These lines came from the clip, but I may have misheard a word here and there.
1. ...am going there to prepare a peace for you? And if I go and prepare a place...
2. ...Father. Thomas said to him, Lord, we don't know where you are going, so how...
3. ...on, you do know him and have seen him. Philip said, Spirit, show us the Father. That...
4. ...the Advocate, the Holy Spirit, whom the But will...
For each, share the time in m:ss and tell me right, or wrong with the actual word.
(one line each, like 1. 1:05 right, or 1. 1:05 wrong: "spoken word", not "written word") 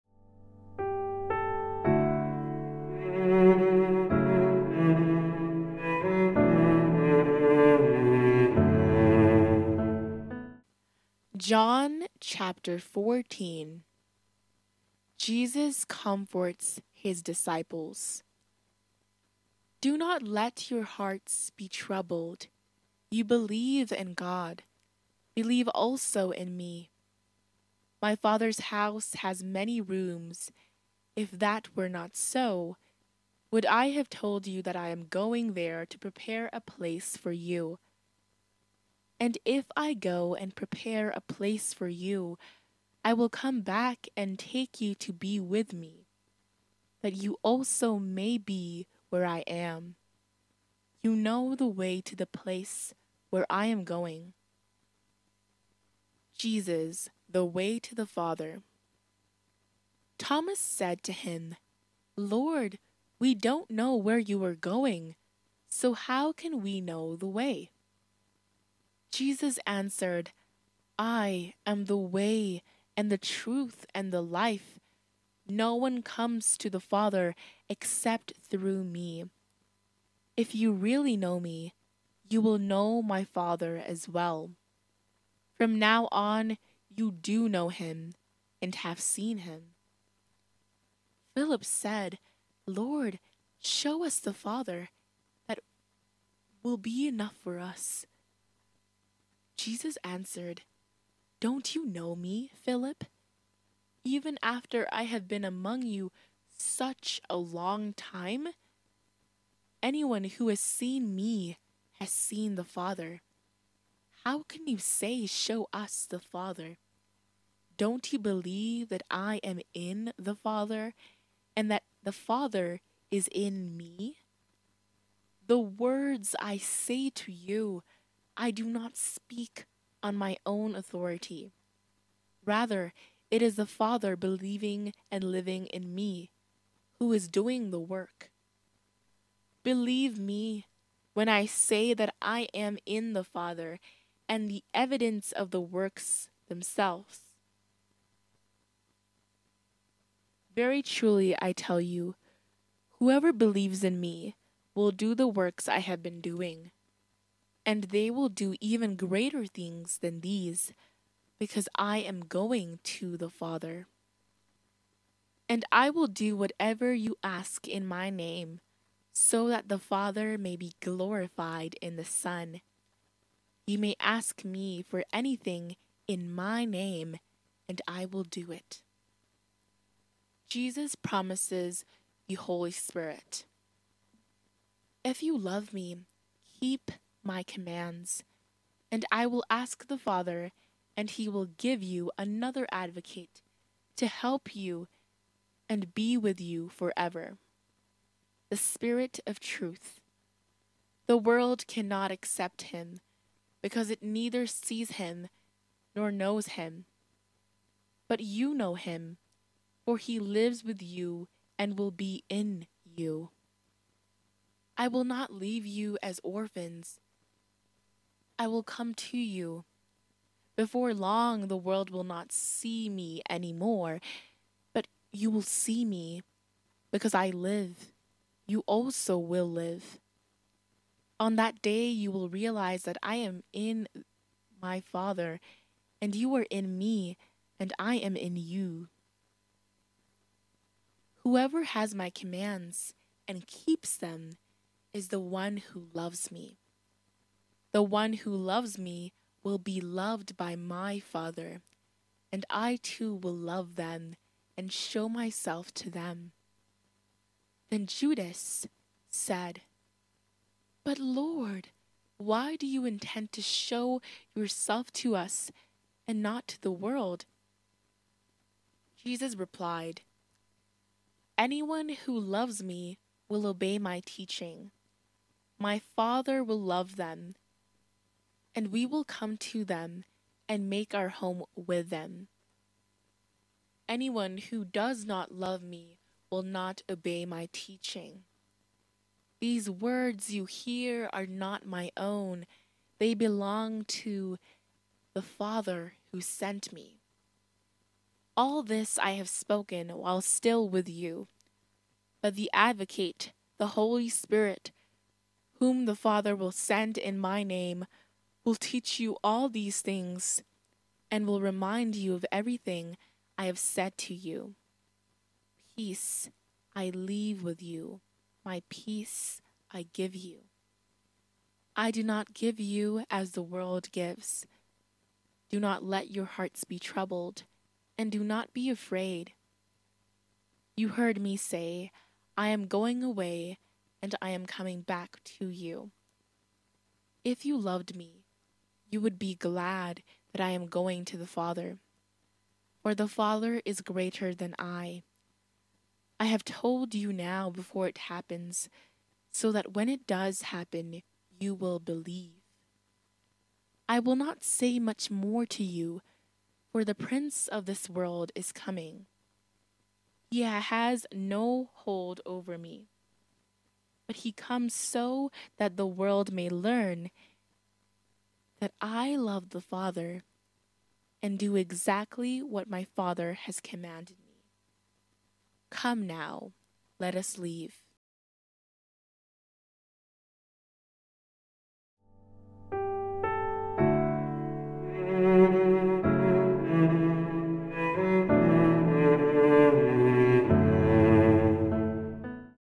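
1. 0:34 wrong: "place", not "peace"
2. 0:58 right
3. 1:26 wrong: "Lord", not "Spirit"
4. 5:02 wrong: "Father", not "But".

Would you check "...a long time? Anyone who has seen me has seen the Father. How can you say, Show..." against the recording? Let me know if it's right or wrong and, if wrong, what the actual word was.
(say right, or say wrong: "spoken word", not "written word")
right.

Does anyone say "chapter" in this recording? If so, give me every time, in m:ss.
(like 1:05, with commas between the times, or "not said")
0:12.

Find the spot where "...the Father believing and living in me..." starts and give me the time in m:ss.
2:13.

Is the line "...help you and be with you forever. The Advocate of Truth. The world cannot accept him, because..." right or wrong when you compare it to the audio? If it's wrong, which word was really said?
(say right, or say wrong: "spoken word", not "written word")
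wrong: "Spirit", not "Advocate".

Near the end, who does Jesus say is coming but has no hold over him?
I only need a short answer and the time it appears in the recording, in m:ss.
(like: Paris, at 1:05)
the prince of this world, at 5:56.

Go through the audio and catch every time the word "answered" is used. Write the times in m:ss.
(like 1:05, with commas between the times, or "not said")
1:09, 1:40.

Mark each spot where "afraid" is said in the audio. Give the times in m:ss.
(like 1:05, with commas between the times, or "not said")
5:28.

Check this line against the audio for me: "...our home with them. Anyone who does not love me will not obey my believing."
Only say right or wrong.
wrong.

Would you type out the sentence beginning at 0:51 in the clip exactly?
You know the way to the place where I am going.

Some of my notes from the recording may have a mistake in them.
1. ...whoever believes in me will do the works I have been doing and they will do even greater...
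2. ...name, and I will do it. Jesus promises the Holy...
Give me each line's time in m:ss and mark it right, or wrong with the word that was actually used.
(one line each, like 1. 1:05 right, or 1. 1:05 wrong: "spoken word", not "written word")
1. 2:32 right
2. 2:56 right.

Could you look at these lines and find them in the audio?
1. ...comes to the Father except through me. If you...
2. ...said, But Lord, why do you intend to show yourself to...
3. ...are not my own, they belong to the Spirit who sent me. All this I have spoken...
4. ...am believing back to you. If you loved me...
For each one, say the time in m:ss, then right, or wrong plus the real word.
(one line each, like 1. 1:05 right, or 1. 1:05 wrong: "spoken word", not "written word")
1. 1:16 right
2. 4:19 right
3. 4:51 wrong: "Father", not "Spirit"
4. 5:34 wrong: "coming", not "believing".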